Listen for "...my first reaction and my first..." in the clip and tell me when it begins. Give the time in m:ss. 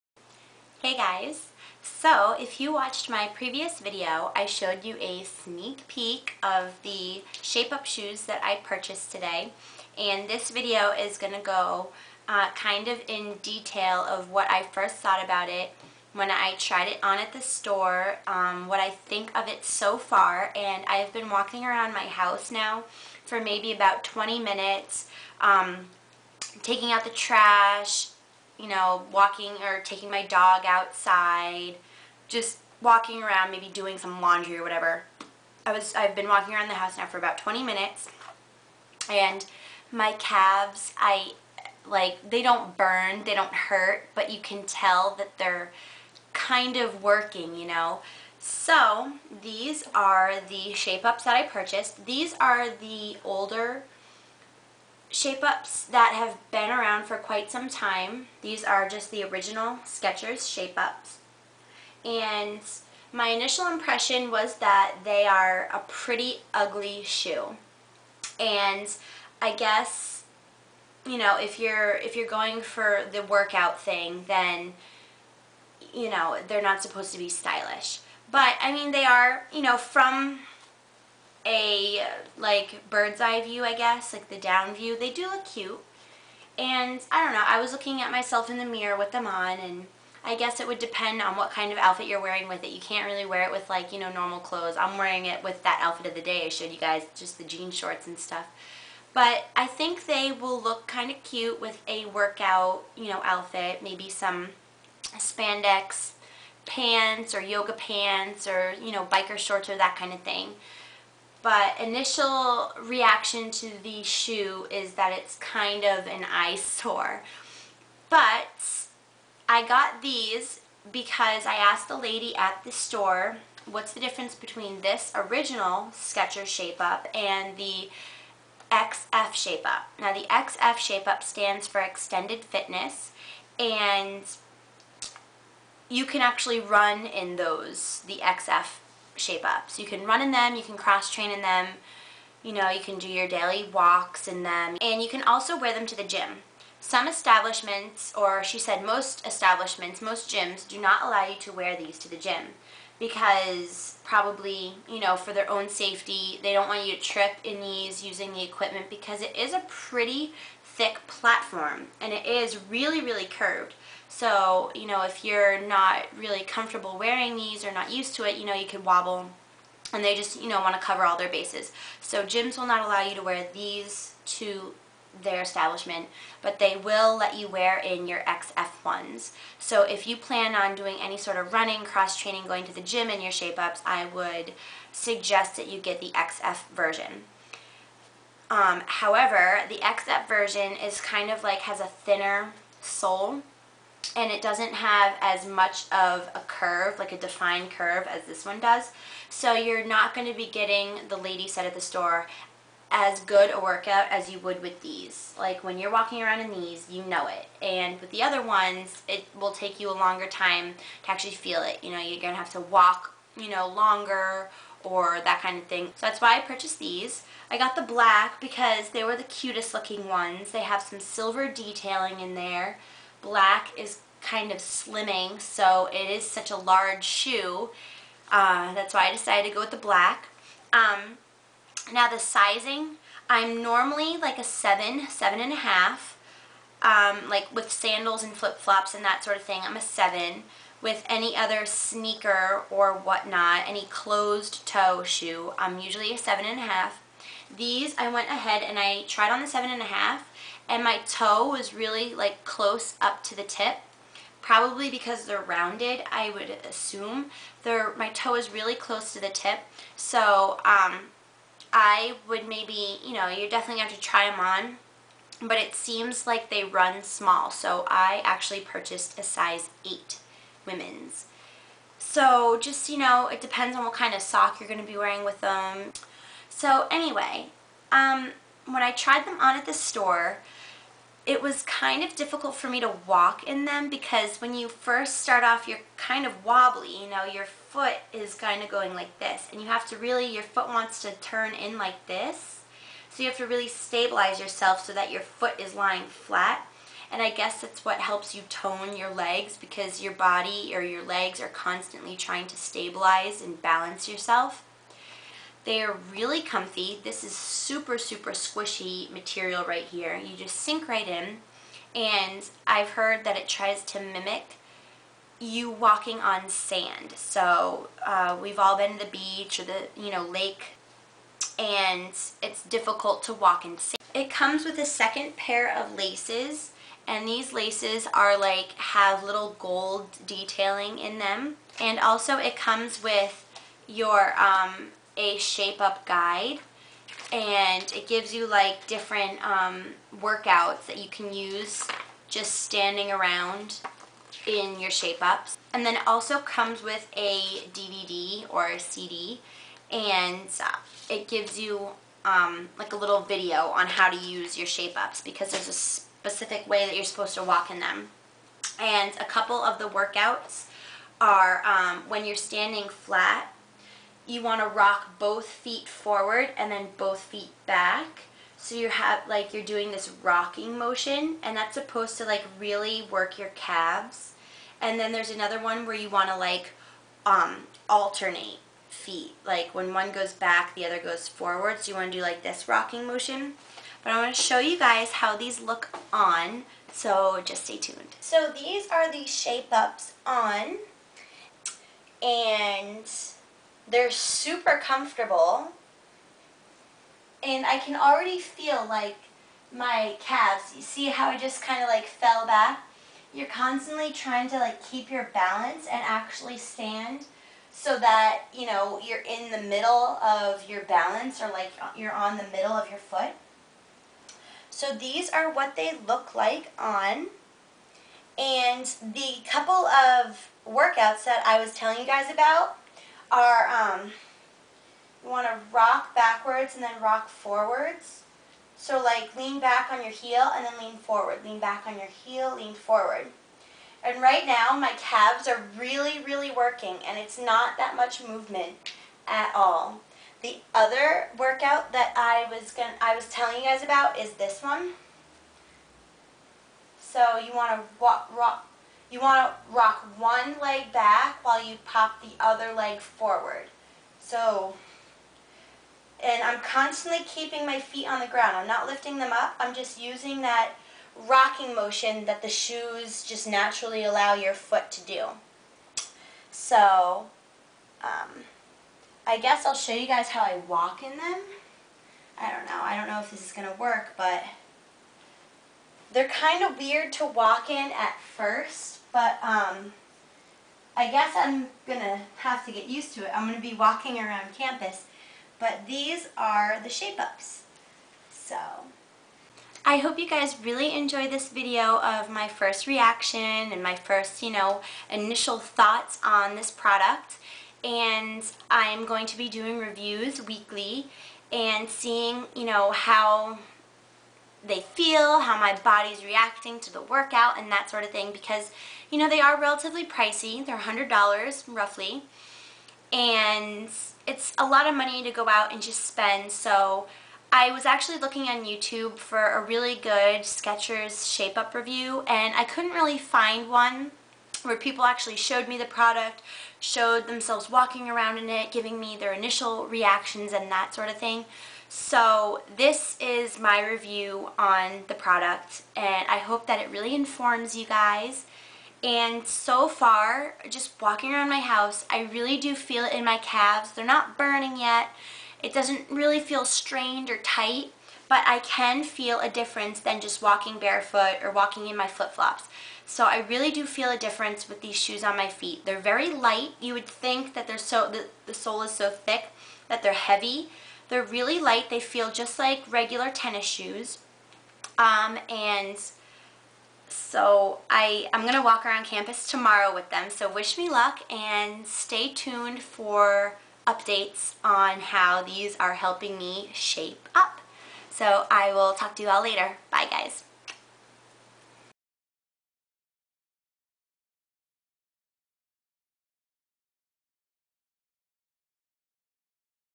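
8:12.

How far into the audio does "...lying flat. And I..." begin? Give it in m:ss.
4:55.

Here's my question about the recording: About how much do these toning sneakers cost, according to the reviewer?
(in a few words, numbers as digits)
$100.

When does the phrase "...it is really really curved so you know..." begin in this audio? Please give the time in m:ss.
2:42.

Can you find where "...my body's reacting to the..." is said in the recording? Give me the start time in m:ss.
8:25.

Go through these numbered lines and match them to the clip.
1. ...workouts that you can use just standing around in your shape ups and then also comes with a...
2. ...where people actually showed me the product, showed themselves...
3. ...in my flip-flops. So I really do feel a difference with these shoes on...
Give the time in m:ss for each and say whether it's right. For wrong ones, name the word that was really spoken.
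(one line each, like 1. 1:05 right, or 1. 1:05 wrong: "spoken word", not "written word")
1. 5:40 right
2. 8:44 right
3. 9:11 right.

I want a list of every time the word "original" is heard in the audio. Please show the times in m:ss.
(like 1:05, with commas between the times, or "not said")
0:59, 2:05.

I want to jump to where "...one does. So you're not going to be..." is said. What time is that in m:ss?
3:18.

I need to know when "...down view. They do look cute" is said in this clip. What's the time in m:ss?
1:24.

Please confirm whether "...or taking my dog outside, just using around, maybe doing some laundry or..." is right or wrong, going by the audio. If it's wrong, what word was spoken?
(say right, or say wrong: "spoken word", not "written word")
wrong: "walking", not "using".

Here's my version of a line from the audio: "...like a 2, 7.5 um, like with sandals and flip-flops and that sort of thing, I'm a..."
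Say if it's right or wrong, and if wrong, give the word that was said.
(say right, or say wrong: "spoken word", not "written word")
wrong: "7", not "2".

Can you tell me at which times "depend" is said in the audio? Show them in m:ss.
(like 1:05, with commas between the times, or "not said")
1:30, 4:33.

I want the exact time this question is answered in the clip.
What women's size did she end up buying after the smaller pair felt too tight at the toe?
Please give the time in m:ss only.
4:29.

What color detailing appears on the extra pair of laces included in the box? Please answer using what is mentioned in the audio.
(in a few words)
Gold.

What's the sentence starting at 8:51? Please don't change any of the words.
So this is my review on the product and I hope that it really informs you guys.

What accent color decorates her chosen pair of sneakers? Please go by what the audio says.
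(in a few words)
Silver.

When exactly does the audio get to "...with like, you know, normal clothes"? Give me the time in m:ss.
1:33.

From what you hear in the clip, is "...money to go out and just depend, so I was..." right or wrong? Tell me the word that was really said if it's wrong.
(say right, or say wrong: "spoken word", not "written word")
wrong: "spend", not "depend".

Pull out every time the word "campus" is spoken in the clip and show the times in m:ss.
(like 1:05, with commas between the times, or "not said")
8:04, 9:29.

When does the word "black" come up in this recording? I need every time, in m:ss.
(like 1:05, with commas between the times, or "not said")
3:37, 3:43, 3:49.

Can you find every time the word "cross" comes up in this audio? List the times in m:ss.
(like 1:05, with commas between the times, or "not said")
2:20, 3:01.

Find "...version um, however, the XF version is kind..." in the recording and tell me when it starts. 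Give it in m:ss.
3:06.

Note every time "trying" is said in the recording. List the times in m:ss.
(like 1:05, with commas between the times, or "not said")
5:02, 6:44.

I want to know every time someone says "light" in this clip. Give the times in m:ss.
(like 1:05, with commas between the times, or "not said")
9:16, 9:21.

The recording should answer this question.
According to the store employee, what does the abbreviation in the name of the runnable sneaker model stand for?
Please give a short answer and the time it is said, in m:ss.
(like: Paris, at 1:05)
Extended Fitness, at 2:11.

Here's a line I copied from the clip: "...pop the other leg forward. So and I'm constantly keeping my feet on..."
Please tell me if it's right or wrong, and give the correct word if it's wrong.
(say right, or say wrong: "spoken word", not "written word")
right.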